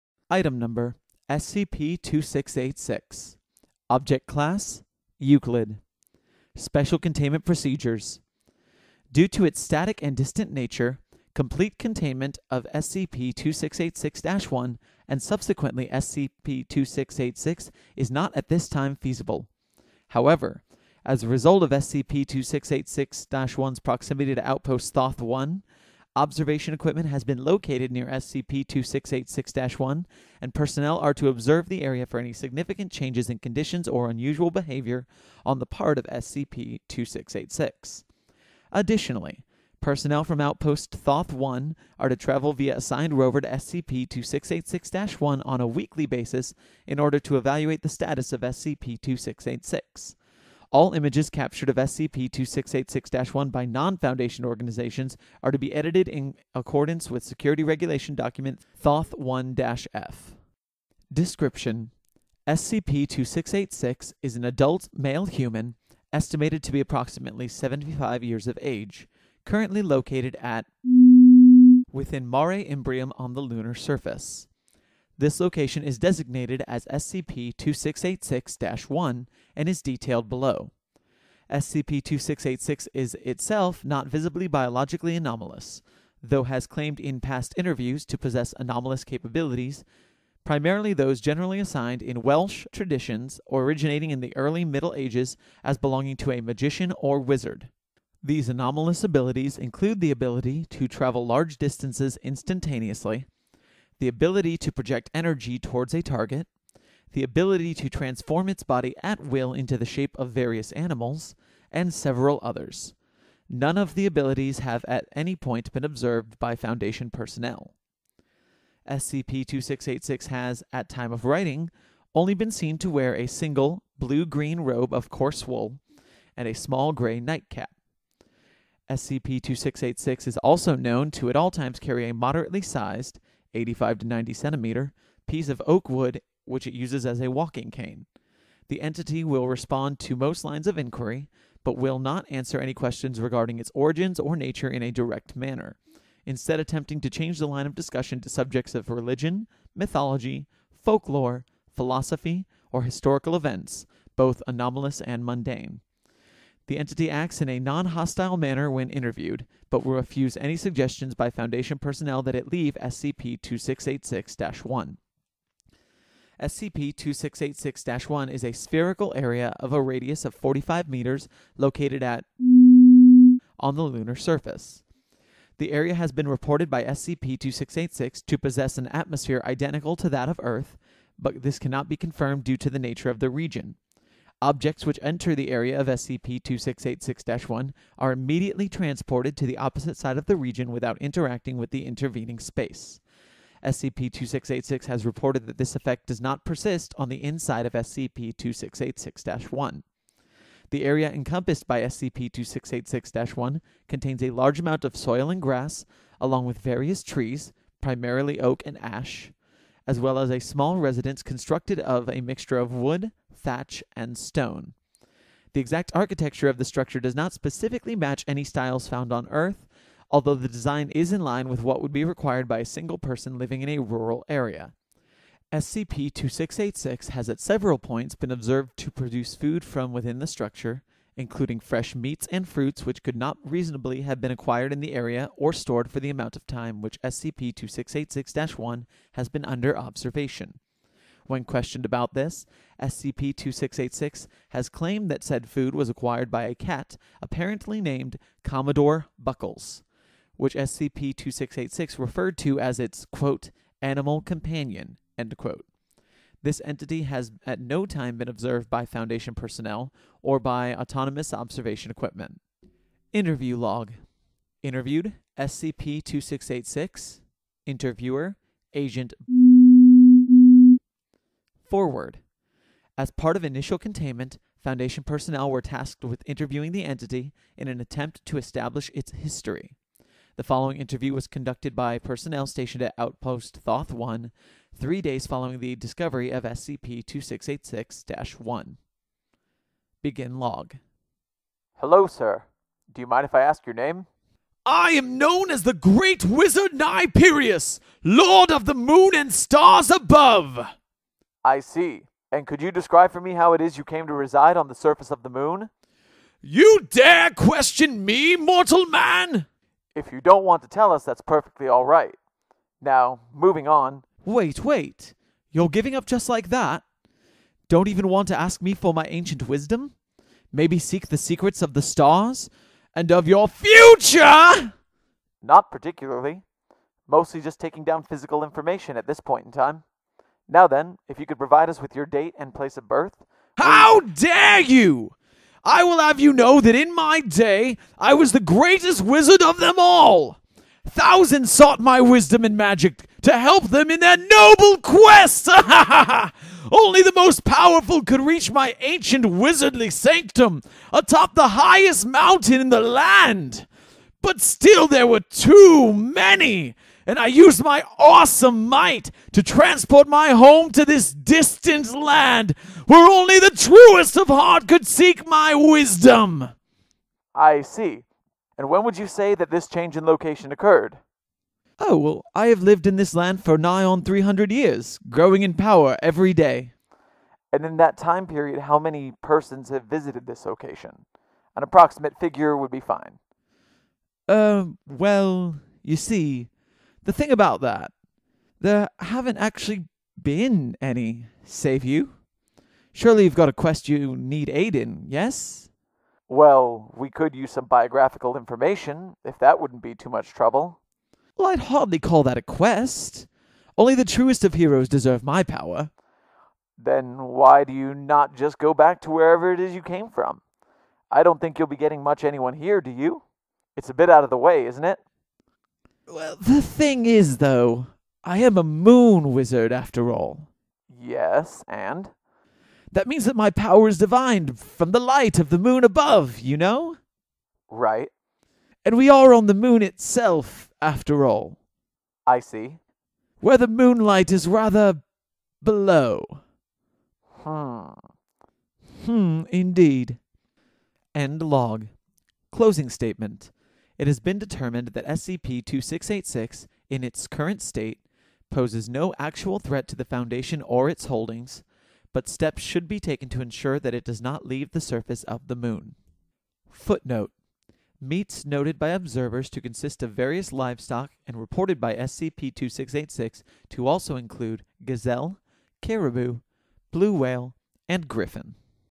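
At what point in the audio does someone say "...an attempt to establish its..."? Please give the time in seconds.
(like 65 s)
277 s.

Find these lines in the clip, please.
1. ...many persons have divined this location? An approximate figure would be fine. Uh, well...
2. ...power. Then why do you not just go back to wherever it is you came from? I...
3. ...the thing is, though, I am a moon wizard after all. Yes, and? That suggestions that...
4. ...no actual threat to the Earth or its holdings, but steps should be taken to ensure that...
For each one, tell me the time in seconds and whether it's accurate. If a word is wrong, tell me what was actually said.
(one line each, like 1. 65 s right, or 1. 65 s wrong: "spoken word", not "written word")
1. 378 s wrong: "visited", not "divined"
2. 405 s right
3. 416 s wrong: "means", not "suggestions"
4. 448 s wrong: "Foundation", not "Earth".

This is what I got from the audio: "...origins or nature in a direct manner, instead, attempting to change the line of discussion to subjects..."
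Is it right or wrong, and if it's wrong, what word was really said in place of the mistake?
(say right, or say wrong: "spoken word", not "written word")
right.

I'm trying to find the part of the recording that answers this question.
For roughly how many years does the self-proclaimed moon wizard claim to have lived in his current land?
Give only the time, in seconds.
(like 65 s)
374 s.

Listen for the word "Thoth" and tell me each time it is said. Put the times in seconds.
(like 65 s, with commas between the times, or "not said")
24 s, 40 s, 58 s, 283 s.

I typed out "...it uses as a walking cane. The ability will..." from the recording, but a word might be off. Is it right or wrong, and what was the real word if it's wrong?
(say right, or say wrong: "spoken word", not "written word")
wrong: "entity", not "ability".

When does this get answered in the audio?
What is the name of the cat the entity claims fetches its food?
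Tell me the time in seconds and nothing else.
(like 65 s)
248 s.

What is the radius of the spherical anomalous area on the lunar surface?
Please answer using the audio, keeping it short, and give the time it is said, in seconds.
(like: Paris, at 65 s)
45 meters, at 170 s.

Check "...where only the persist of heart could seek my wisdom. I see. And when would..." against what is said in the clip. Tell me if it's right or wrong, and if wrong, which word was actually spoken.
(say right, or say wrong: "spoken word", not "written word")
wrong: "truest", not "persist".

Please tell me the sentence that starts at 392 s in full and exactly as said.
Surely you've got a quest you need aid in, yes?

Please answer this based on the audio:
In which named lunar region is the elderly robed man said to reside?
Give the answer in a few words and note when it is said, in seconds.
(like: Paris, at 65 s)
Mare Imbrium, at 72 s.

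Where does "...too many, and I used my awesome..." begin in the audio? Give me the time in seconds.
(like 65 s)
355 s.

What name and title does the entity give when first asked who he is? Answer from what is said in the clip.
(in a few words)
Great Wizard Niperius.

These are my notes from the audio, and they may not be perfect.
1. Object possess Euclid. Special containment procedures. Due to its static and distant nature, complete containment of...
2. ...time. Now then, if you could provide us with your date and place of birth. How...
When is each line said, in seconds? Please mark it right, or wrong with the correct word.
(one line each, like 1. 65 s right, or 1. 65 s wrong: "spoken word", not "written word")
1. 3 s wrong: "class", not "possess"
2. 329 s right.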